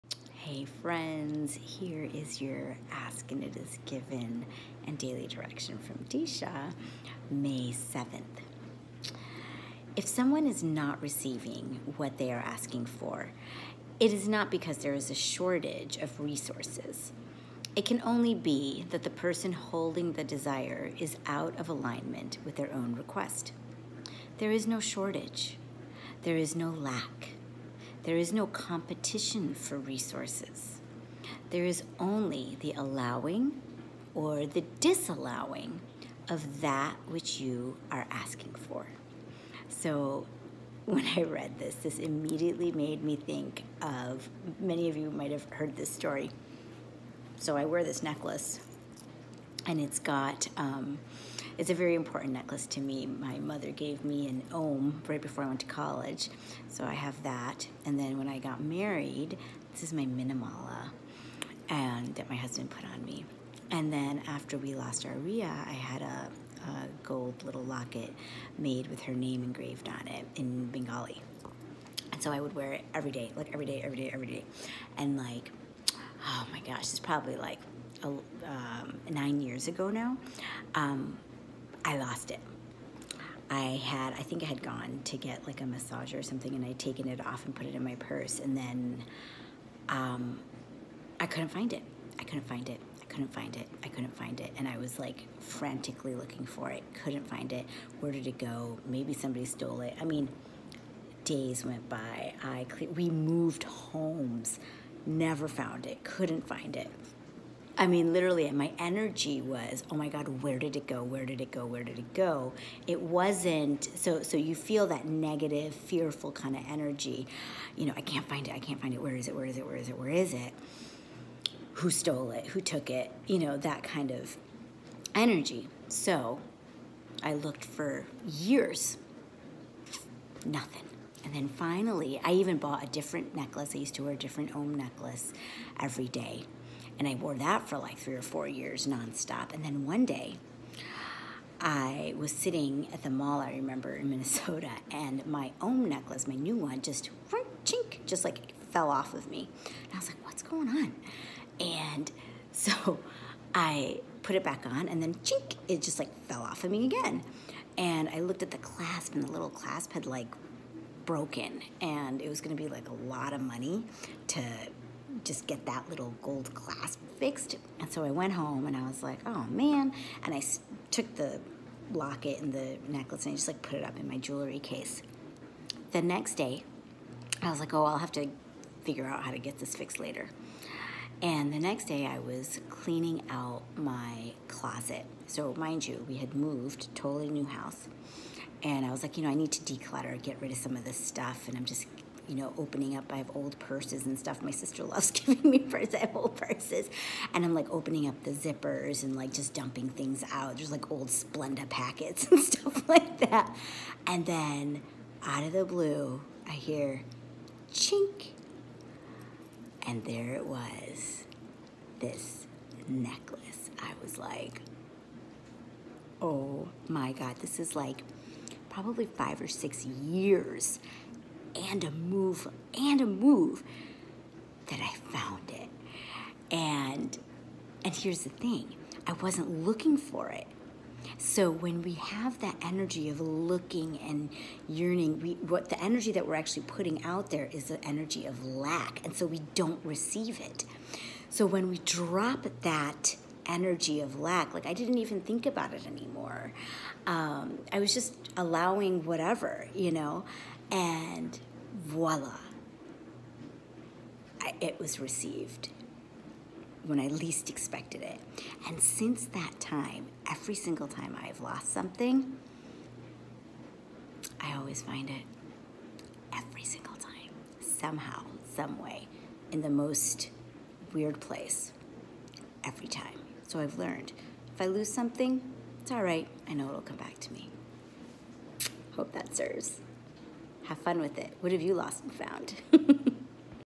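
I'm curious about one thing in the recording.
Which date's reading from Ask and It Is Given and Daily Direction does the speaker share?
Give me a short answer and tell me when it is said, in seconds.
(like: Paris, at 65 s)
May 7th, at 7 s.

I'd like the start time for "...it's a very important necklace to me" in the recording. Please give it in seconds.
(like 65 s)
51 s.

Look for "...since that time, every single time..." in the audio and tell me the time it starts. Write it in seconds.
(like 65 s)
258 s.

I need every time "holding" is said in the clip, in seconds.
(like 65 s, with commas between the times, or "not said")
19 s.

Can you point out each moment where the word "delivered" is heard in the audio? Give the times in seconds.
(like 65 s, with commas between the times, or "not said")
not said.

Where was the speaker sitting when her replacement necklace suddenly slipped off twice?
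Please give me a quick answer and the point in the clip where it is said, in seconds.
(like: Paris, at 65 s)
the mall, at 143 s.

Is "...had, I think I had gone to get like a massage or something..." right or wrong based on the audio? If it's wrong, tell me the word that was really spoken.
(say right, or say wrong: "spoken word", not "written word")
right.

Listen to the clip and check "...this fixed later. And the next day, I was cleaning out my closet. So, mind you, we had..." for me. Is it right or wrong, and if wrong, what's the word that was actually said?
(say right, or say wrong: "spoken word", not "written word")
right.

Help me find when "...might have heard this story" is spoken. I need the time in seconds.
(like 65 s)
45 s.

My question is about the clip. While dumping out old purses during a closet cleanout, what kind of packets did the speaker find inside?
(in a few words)
Splenda.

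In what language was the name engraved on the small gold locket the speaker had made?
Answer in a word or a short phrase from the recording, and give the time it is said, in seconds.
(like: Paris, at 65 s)
Bengali, at 70 s.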